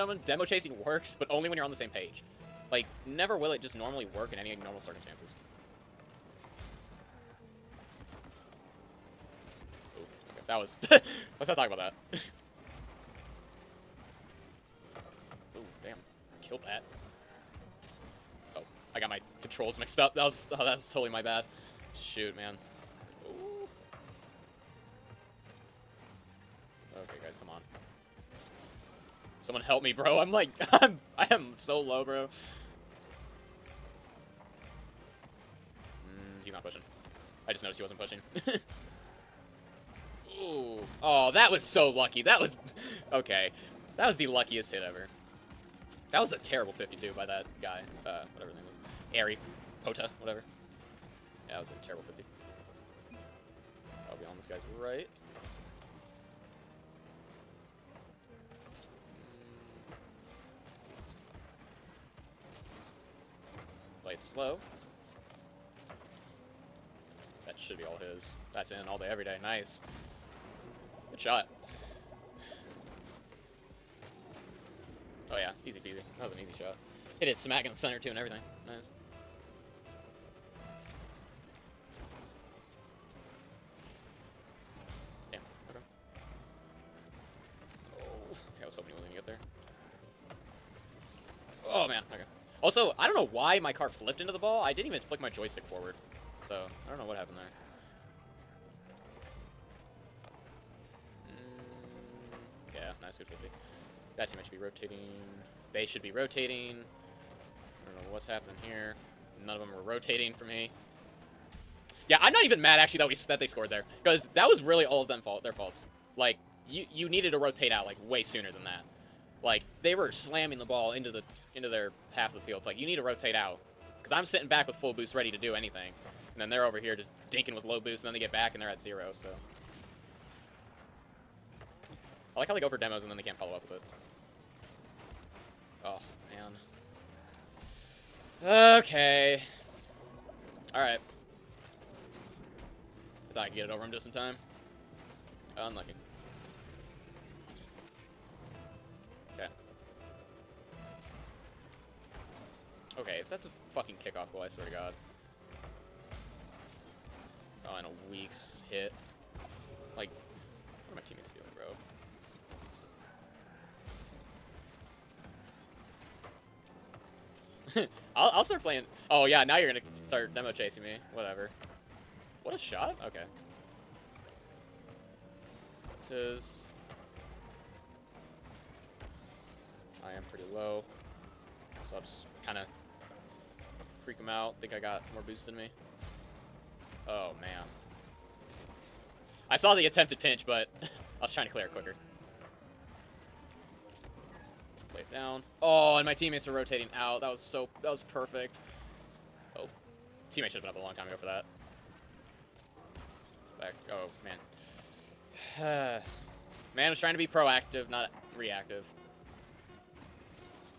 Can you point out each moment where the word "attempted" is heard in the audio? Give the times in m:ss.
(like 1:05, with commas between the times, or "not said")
3:09.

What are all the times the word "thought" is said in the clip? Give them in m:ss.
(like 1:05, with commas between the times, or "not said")
2:23.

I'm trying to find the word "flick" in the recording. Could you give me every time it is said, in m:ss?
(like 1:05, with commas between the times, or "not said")
1:35.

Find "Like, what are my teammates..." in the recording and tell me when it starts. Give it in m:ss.
2:39.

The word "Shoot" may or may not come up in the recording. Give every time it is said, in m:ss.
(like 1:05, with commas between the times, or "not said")
0:22.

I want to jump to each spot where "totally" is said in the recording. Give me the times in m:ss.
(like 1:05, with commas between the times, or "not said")
0:20.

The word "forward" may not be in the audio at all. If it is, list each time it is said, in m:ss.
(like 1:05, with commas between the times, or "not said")
1:35.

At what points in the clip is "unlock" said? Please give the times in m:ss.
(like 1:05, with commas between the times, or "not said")
not said.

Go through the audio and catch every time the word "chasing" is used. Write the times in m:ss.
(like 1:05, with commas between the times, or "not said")
0:00, 2:50.